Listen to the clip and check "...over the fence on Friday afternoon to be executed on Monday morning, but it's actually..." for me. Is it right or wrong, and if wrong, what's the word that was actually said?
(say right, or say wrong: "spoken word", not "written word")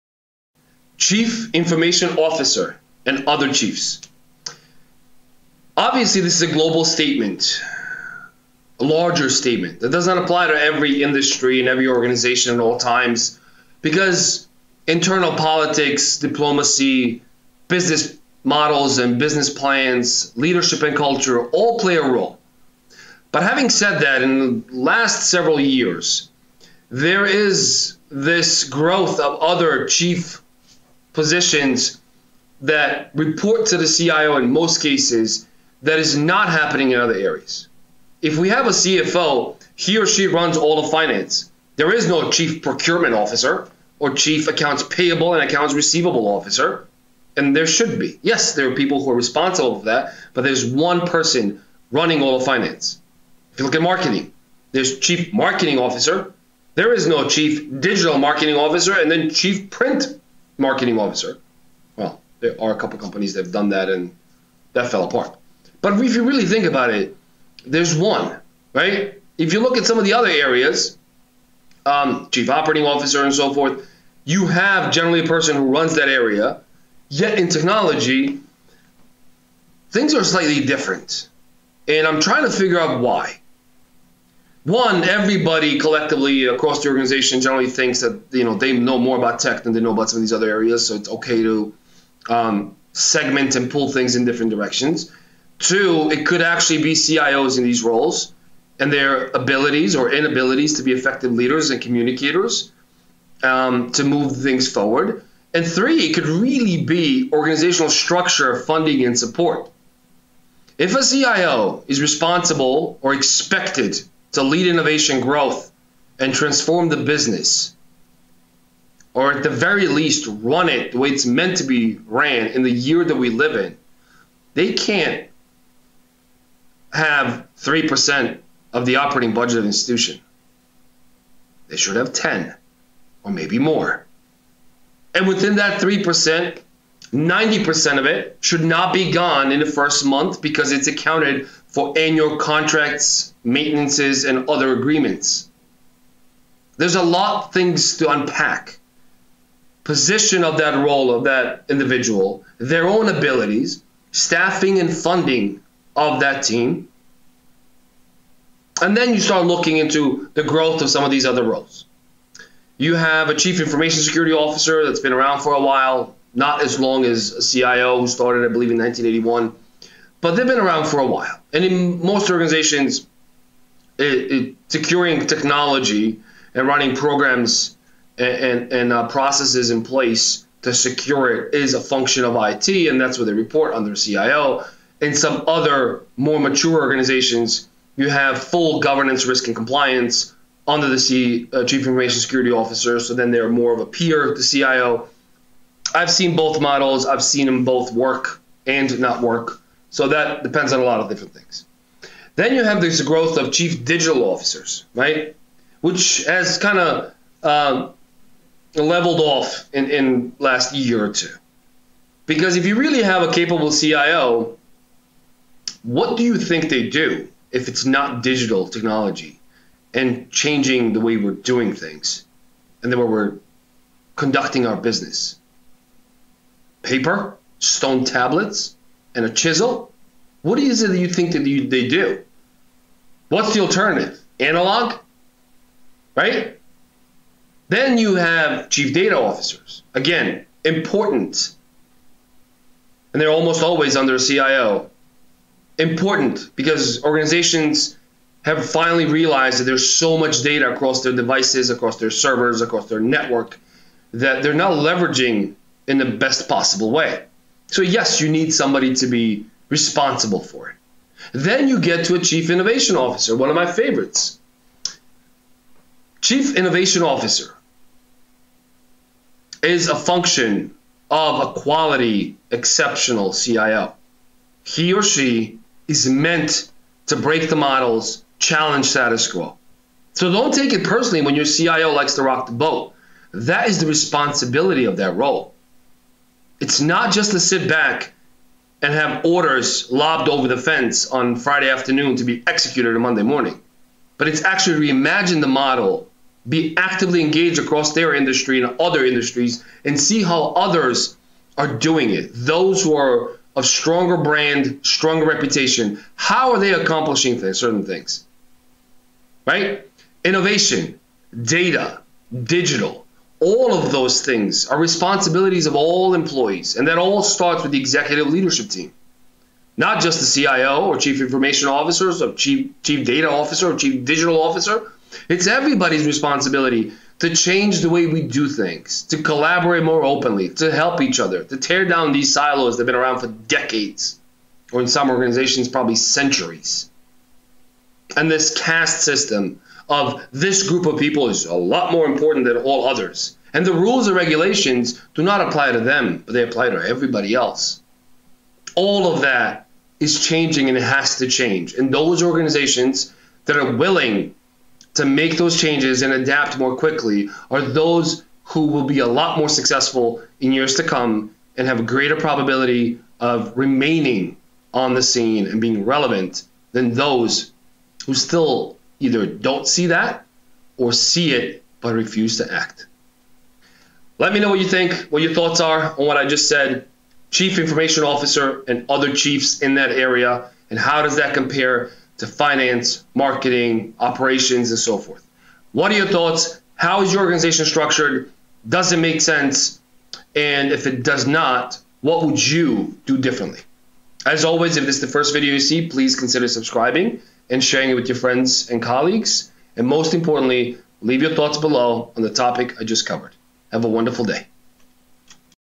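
right.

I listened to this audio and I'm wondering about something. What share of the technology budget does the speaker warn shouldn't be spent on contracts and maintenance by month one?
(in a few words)
90%.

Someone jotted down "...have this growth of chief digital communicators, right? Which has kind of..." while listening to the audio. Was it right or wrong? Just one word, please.
wrong.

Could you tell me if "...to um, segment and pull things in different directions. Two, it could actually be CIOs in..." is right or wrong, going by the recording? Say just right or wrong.
right.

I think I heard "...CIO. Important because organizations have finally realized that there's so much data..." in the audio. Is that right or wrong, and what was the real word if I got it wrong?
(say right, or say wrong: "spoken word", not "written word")
right.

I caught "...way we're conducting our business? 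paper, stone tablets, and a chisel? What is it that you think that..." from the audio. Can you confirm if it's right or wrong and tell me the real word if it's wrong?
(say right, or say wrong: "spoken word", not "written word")
right.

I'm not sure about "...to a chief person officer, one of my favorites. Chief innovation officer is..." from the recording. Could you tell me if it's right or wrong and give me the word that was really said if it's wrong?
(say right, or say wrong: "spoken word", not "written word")
wrong: "innovation", not "person".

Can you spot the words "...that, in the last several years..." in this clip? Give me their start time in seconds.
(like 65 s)
24 s.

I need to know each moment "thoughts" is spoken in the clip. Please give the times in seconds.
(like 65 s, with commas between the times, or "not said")
375 s, 386 s, 401 s.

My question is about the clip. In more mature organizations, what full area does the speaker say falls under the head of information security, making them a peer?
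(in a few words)
governance, risk, and compliance.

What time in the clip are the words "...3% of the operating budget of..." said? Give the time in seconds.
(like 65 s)
127 s.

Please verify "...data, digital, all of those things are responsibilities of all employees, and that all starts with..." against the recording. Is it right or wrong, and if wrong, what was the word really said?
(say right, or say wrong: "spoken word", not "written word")
right.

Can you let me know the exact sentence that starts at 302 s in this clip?
Those who are of stronger brand, stronger reputation, how are they accomplishing things, certain things?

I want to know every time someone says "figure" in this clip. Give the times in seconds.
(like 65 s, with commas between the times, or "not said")
82 s.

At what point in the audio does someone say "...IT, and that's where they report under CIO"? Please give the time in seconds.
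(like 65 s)
182 s.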